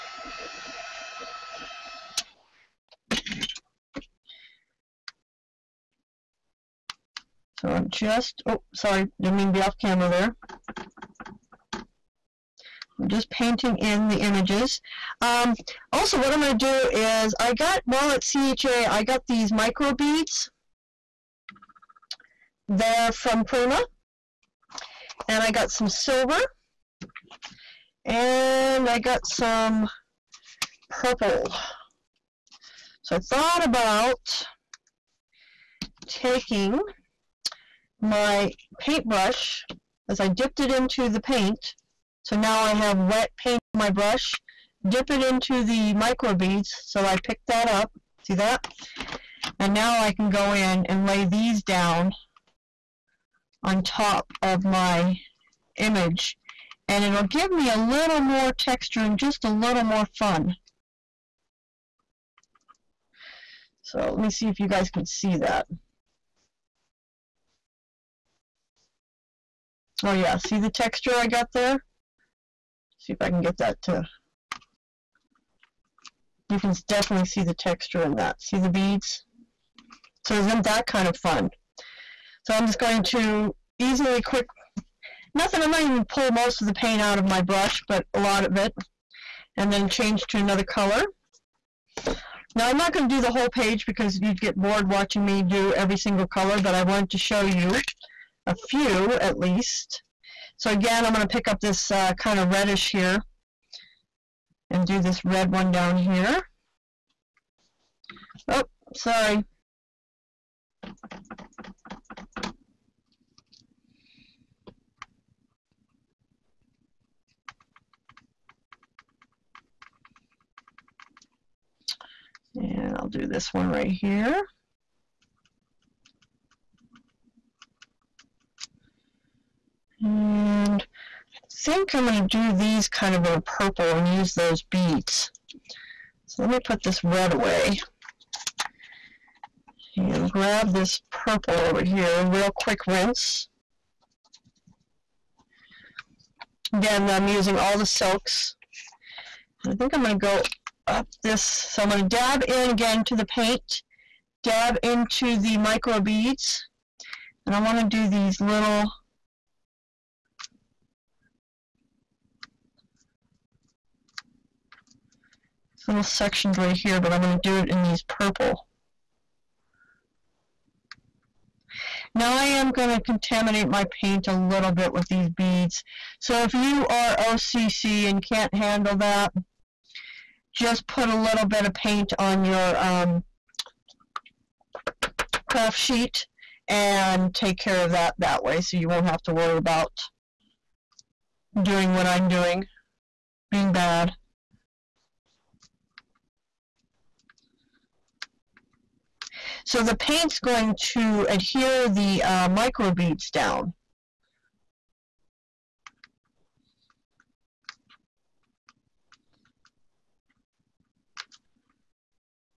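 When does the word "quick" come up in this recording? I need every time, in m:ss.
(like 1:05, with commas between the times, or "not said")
1:24, 2:22.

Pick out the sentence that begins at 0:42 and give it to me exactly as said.
So now I have wet paint on my brush.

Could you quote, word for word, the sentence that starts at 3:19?
So the paint's going to adhere the uh, microbeads down.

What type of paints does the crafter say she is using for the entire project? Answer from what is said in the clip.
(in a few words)
silks.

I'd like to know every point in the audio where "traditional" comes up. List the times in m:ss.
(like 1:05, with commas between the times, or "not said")
not said.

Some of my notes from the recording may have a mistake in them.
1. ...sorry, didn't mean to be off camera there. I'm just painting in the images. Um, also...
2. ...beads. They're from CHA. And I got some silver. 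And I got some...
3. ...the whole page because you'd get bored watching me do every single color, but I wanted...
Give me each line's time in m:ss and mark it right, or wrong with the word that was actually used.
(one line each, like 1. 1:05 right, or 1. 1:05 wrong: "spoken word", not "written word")
1. 0:08 right
2. 0:19 wrong: "Prima", not "CHA"
3. 1:33 right.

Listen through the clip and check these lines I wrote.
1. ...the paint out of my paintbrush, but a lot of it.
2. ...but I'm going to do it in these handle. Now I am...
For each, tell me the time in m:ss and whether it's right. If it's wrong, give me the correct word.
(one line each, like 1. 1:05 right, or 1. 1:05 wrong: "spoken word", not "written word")
1. 1:26 wrong: "brush", not "paintbrush"
2. 2:46 wrong: "purple", not "handle".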